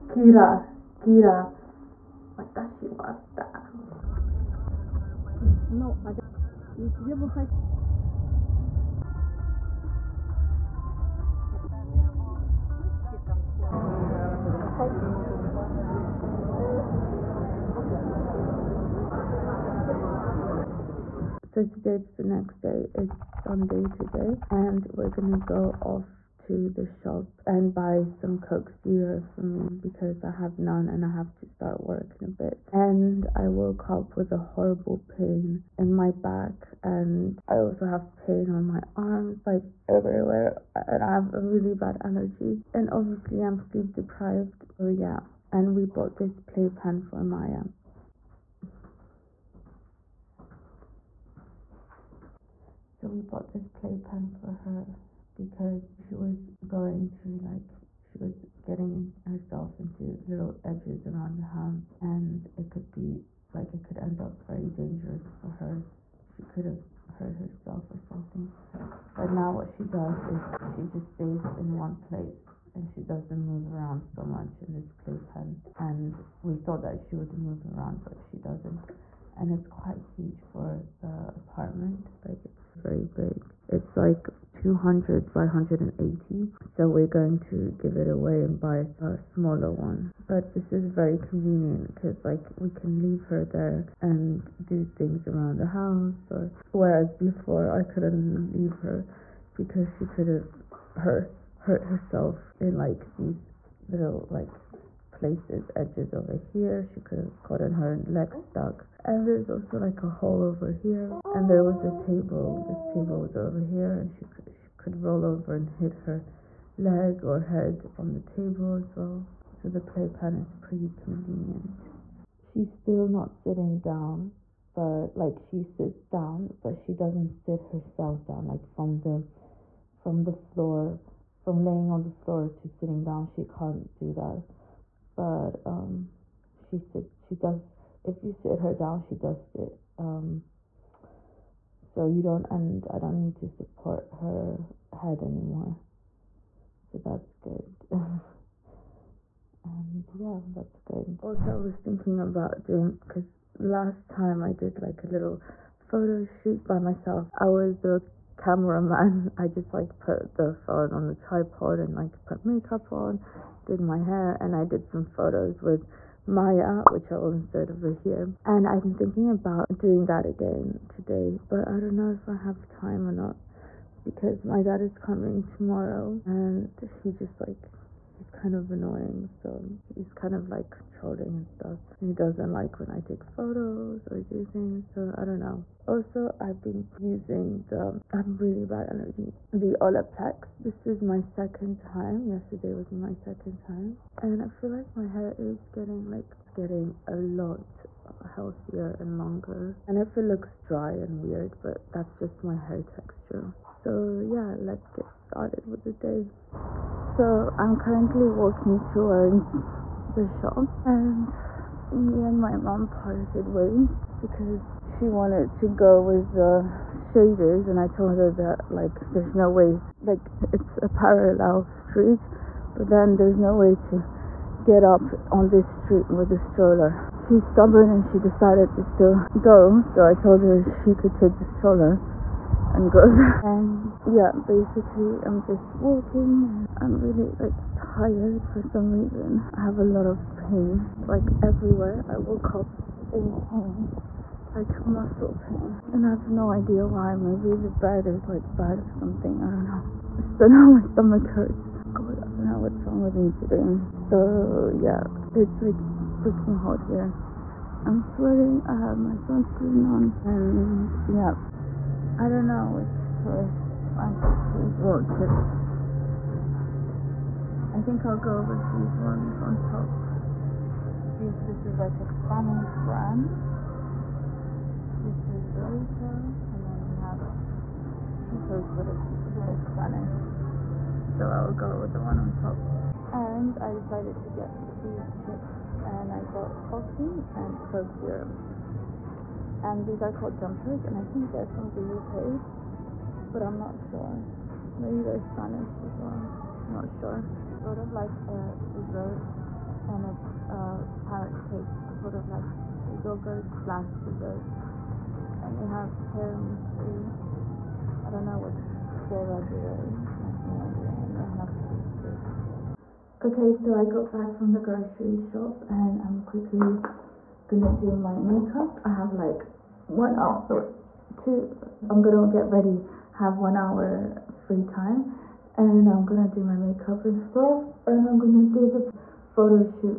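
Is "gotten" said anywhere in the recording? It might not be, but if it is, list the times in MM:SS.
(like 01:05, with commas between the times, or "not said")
01:47.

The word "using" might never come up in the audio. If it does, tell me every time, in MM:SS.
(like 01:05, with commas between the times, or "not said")
03:06.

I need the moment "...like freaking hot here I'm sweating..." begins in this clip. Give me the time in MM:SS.
04:15.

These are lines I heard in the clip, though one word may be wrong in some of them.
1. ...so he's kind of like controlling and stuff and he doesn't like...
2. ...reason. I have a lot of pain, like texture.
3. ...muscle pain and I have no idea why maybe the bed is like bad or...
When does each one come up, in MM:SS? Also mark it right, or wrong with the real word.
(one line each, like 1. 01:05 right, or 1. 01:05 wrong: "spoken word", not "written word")
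1. 02:59 right
2. 03:58 wrong: "everywhere", not "texture"
3. 04:04 right.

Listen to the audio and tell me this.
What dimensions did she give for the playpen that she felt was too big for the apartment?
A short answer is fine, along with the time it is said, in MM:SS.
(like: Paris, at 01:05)
200 by 180, at 01:24.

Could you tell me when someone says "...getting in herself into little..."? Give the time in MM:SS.
00:58.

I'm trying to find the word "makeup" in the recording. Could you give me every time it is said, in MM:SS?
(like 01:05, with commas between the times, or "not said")
02:42, 05:18, 05:26.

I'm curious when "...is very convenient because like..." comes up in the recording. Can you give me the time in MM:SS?
01:30.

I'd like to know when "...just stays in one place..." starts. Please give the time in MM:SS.
01:10.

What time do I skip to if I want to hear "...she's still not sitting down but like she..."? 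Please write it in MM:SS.
02:02.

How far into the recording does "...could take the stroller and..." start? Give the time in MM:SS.
03:50.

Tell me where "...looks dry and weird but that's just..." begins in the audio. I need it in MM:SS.
03:20.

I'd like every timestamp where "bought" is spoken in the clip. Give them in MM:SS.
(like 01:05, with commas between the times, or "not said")
00:45, 00:53.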